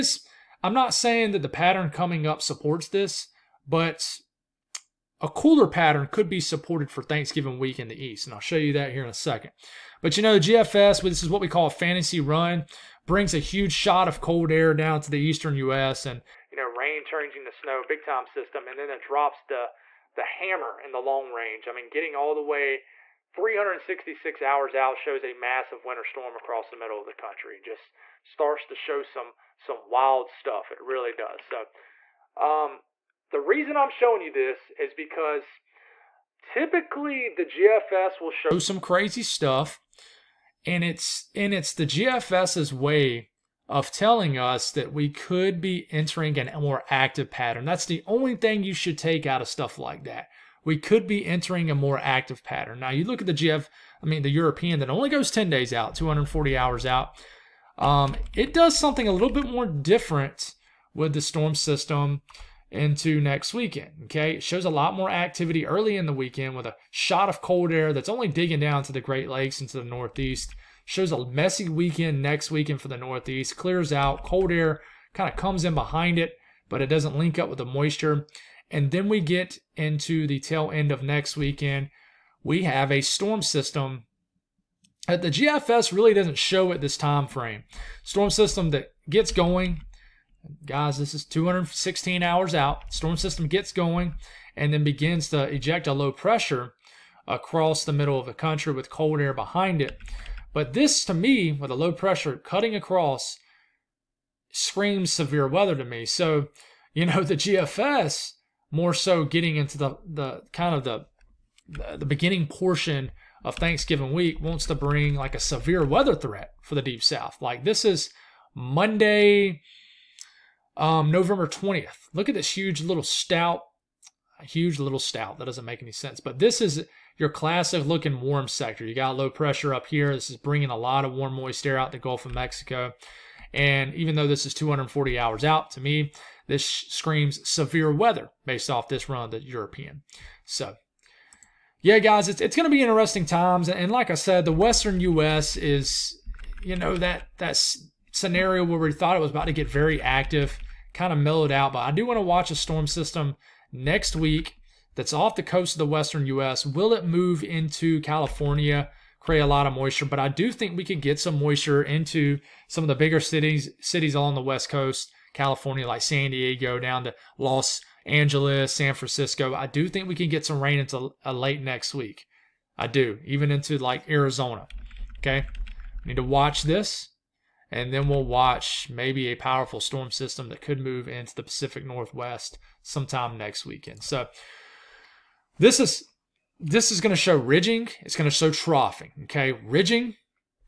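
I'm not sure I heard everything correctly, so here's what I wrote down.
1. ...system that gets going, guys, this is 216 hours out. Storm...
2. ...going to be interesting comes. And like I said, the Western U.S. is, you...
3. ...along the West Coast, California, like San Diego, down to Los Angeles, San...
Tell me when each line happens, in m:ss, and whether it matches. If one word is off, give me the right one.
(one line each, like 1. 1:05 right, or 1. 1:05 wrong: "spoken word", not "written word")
1. 1:28 right
2. 2:22 wrong: "times", not "comes"
3. 2:44 right.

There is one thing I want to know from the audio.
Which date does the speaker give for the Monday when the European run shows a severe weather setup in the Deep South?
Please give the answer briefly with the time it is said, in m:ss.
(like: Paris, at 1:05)
November 20th, at 2:01.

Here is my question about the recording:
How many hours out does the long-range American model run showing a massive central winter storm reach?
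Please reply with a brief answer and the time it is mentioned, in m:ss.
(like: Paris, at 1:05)
366, at 0:23.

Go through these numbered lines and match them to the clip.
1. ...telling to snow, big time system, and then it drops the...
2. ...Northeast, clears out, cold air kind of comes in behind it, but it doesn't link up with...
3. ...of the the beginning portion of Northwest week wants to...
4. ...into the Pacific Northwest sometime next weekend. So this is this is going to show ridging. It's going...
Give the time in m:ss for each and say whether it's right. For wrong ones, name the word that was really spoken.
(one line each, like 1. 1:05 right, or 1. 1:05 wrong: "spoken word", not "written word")
1. 0:17 wrong: "changing", not "telling"
2. 1:12 right
3. 1:50 wrong: "Thanksgiving", not "Northwest"
4. 3:01 right.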